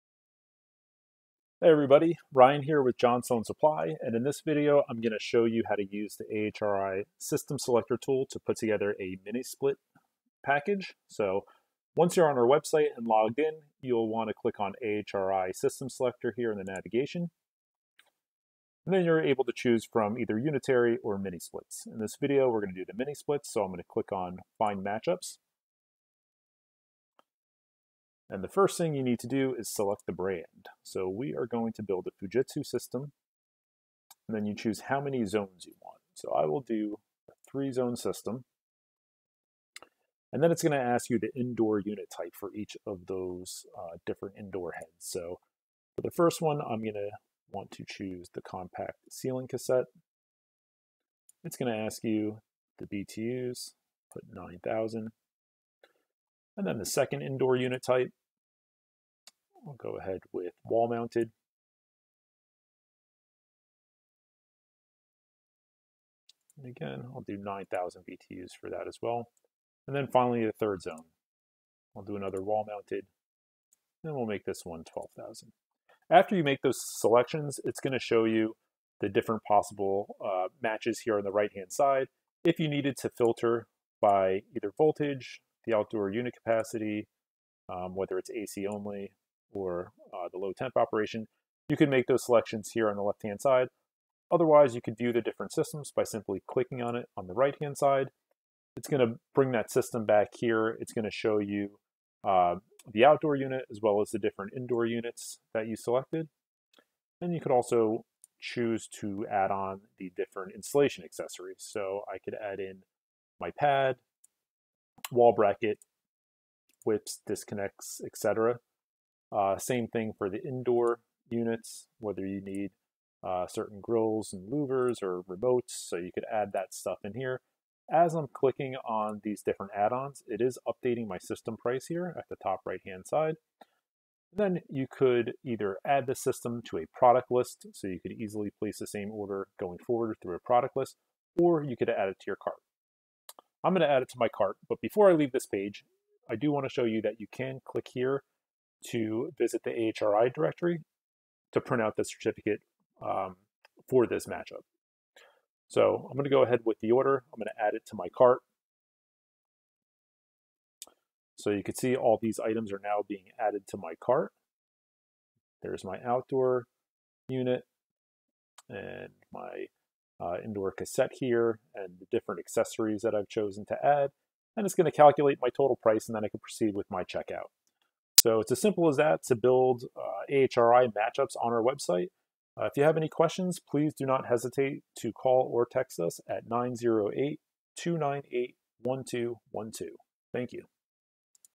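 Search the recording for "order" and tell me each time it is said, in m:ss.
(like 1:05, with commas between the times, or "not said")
2:19, 2:36.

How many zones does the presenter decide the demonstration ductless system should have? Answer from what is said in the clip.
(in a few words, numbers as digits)
3.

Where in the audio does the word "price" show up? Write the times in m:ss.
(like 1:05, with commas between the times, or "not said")
2:11, 2:55.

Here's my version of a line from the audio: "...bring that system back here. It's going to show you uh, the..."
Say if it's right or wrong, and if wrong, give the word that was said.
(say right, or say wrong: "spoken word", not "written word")
right.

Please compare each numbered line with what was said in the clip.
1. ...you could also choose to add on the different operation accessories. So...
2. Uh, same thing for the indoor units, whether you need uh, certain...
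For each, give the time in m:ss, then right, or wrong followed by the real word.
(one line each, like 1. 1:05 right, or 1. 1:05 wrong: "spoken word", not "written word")
1. 1:47 wrong: "installation", not "operation"
2. 1:59 right.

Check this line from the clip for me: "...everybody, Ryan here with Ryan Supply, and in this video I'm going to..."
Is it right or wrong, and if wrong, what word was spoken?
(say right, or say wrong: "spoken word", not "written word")
wrong: "Johnstone", not "Ryan".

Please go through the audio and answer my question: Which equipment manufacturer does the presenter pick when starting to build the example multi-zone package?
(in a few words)
Fujitsu.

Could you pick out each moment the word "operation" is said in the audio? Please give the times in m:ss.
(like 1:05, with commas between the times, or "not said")
1:30.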